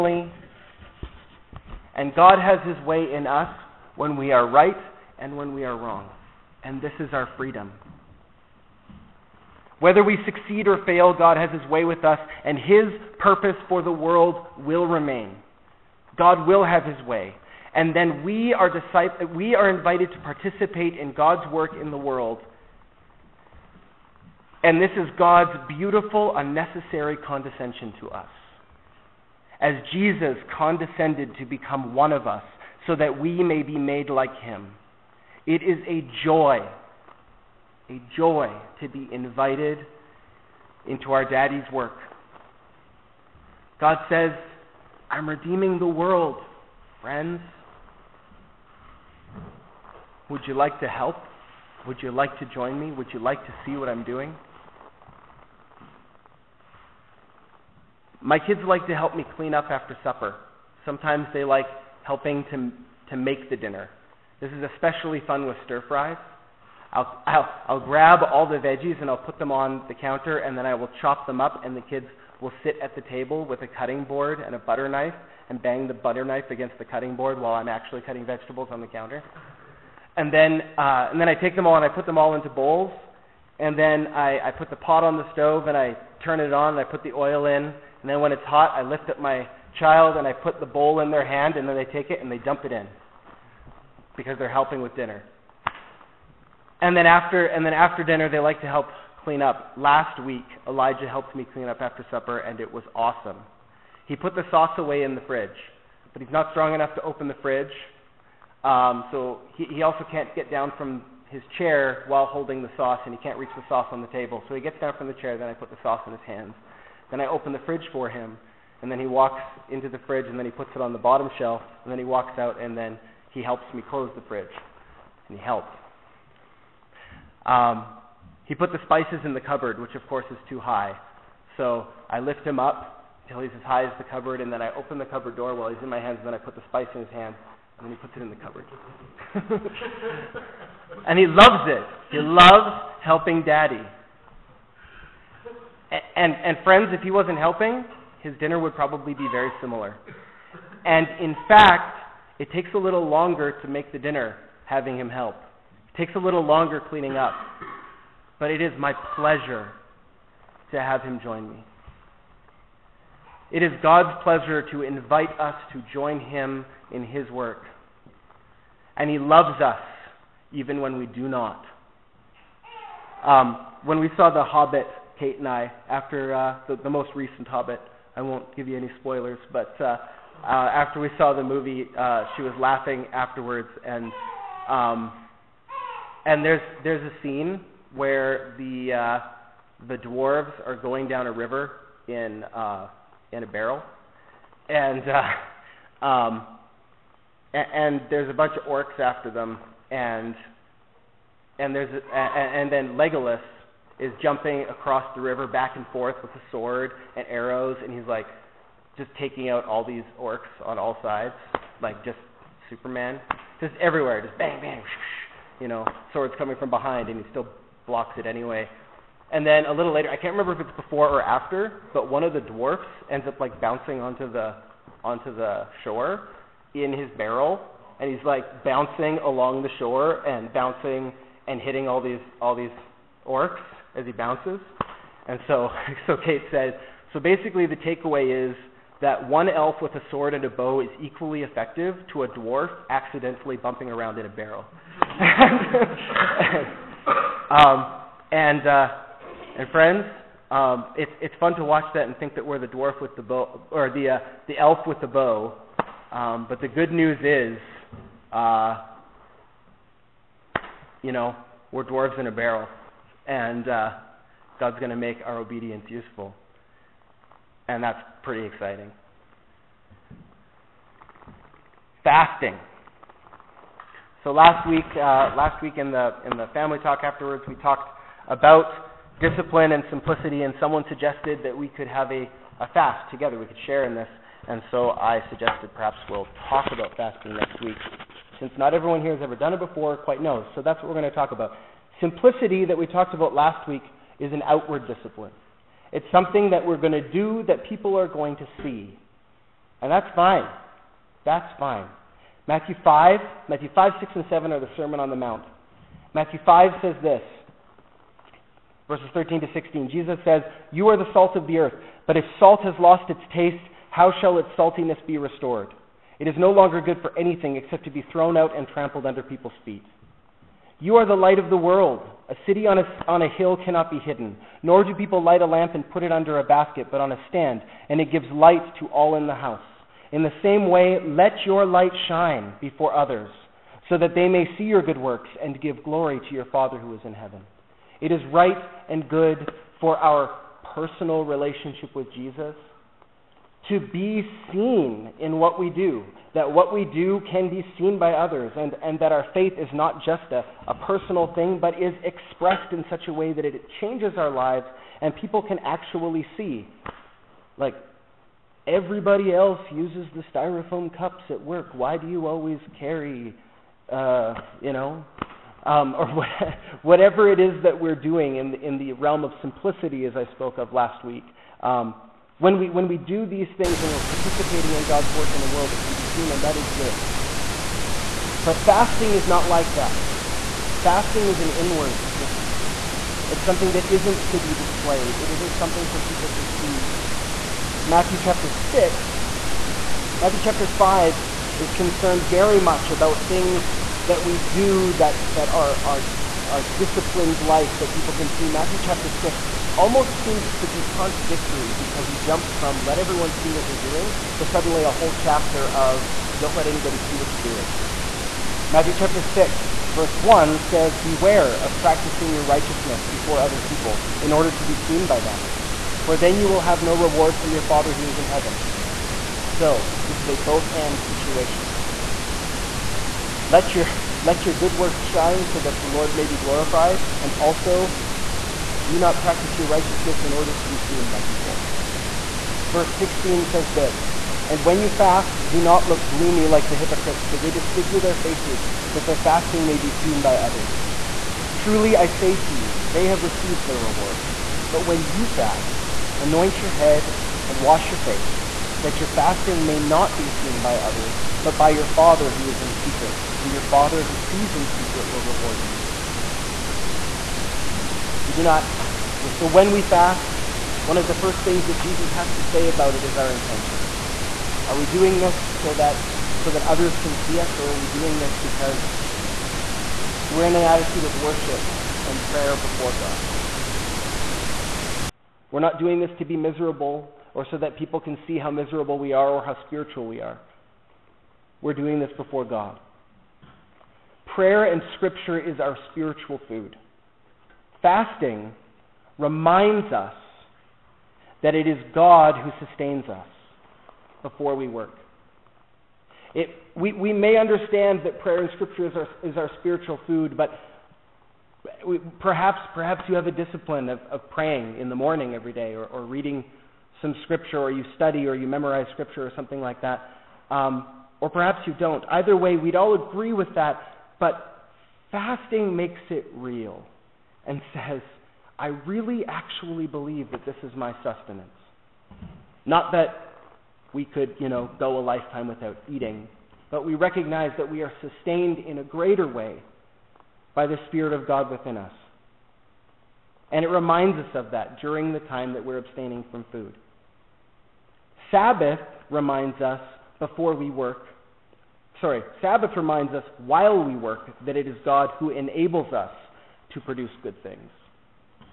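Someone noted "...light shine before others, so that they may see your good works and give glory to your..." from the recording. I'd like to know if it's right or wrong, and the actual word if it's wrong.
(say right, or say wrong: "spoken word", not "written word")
right.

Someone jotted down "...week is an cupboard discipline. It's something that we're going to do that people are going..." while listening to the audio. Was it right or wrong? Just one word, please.
wrong.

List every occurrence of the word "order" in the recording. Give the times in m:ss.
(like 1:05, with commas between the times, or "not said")
6:54, 7:10.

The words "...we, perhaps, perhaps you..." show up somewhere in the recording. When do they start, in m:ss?
8:21.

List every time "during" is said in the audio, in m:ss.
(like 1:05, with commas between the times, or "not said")
8:54.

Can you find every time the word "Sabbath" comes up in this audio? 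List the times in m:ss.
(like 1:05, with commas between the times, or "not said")
8:58, 9:02.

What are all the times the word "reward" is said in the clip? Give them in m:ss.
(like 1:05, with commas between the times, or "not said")
6:56, 7:23, 7:35.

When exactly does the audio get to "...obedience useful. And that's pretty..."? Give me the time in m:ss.
4:25.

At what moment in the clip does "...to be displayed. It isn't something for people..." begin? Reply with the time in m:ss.
6:24.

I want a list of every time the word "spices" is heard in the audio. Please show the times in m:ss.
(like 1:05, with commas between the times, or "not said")
2:08, 2:16.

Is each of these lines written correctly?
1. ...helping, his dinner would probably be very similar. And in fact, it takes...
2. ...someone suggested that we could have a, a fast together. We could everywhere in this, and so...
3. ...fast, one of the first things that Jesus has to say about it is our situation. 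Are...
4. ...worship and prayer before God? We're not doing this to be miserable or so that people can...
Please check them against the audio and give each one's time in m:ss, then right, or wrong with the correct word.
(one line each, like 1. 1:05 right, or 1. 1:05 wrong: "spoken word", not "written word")
1. 2:27 right
2. 4:40 wrong: "share", not "everywhere"
3. 7:39 wrong: "intention", not "situation"
4. 7:51 right.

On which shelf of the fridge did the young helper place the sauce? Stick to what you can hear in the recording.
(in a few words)
bottom shelf.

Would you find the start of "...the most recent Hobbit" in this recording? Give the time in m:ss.
2:56.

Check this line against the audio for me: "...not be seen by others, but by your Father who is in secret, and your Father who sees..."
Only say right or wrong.
right.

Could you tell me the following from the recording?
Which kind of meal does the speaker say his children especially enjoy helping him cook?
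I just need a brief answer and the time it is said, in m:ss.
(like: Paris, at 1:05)
stir fries, at 1:05.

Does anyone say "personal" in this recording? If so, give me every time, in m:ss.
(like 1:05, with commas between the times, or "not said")
5:40, 5:50.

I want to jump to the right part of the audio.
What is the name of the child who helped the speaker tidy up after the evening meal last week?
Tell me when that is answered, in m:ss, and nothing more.
1:40.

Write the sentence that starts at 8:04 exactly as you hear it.
Prayer and Scripture is our spiritual food.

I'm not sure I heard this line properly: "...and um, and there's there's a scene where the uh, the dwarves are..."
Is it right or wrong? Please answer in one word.
right.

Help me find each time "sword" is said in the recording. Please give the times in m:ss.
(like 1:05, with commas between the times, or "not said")
3:26, 3:36, 4:00.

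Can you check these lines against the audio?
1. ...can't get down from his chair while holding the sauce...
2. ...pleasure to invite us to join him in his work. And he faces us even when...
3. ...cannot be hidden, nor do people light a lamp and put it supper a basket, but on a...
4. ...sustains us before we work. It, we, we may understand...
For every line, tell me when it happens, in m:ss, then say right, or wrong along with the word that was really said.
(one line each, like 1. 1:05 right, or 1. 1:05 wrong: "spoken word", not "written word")
1. 1:50 right
2. 2:44 wrong: "loves", not "faces"
3. 5:23 wrong: "under", not "supper"
4. 8:12 right.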